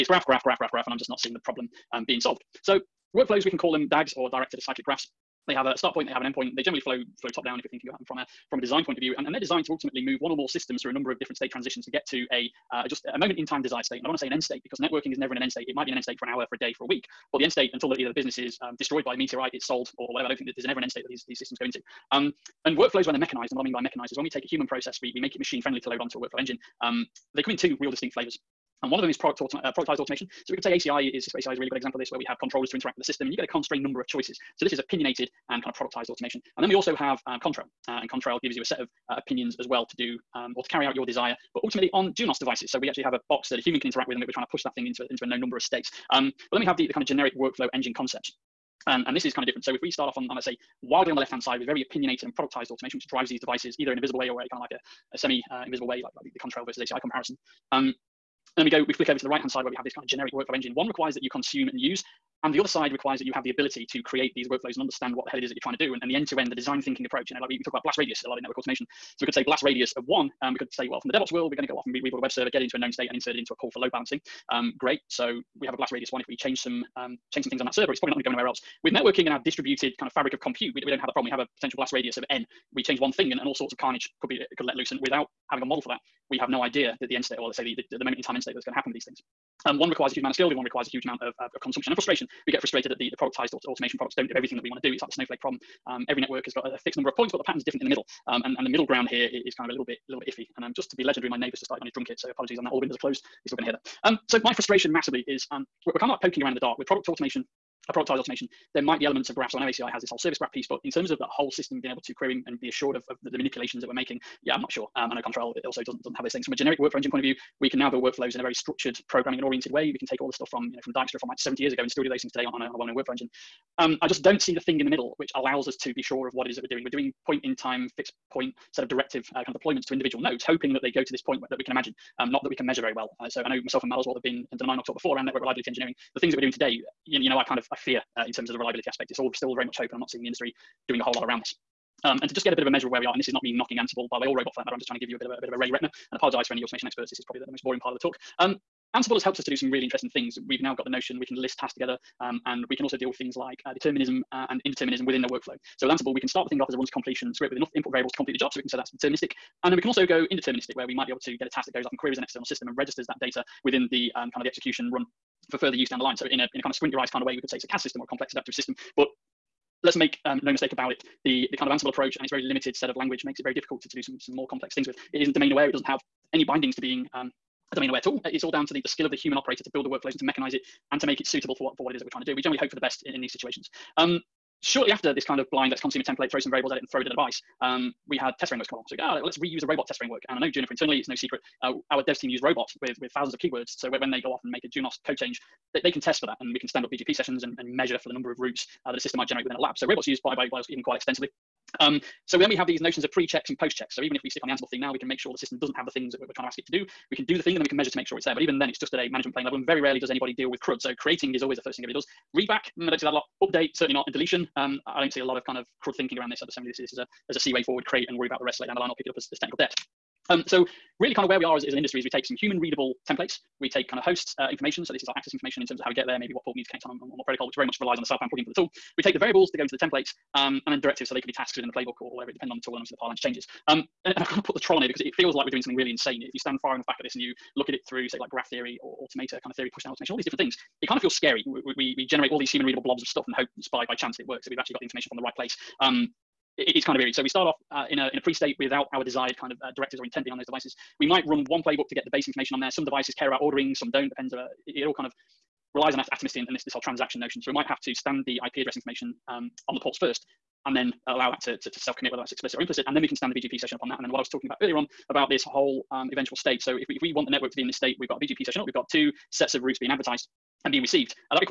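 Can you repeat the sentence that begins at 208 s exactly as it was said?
But even then, it's just at a management plane level, and very rarely does anybody deal with CRUD.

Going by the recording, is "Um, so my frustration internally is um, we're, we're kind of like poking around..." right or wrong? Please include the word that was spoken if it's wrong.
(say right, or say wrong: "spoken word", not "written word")
wrong: "massively", not "internally".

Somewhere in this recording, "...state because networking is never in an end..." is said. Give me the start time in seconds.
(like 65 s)
14 s.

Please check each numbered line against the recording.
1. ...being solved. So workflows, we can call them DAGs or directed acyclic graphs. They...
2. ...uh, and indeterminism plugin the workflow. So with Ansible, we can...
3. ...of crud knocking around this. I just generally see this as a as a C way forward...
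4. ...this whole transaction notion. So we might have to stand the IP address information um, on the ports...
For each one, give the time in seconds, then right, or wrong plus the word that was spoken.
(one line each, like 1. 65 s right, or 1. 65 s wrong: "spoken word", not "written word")
1. 2 s right
2. 154 s wrong: "within", not "plugin"
3. 215 s wrong: "thinking", not "knocking"
4. 256 s right.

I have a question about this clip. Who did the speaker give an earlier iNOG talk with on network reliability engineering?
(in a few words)
Matt Oswald.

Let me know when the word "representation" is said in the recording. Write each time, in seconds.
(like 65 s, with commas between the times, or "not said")
not said.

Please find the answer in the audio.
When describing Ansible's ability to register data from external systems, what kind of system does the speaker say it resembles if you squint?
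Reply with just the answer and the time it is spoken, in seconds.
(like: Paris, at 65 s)
complex adaptive system, at 168 s.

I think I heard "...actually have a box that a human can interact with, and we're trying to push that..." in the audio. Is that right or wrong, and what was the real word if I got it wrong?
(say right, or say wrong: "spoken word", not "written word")
right.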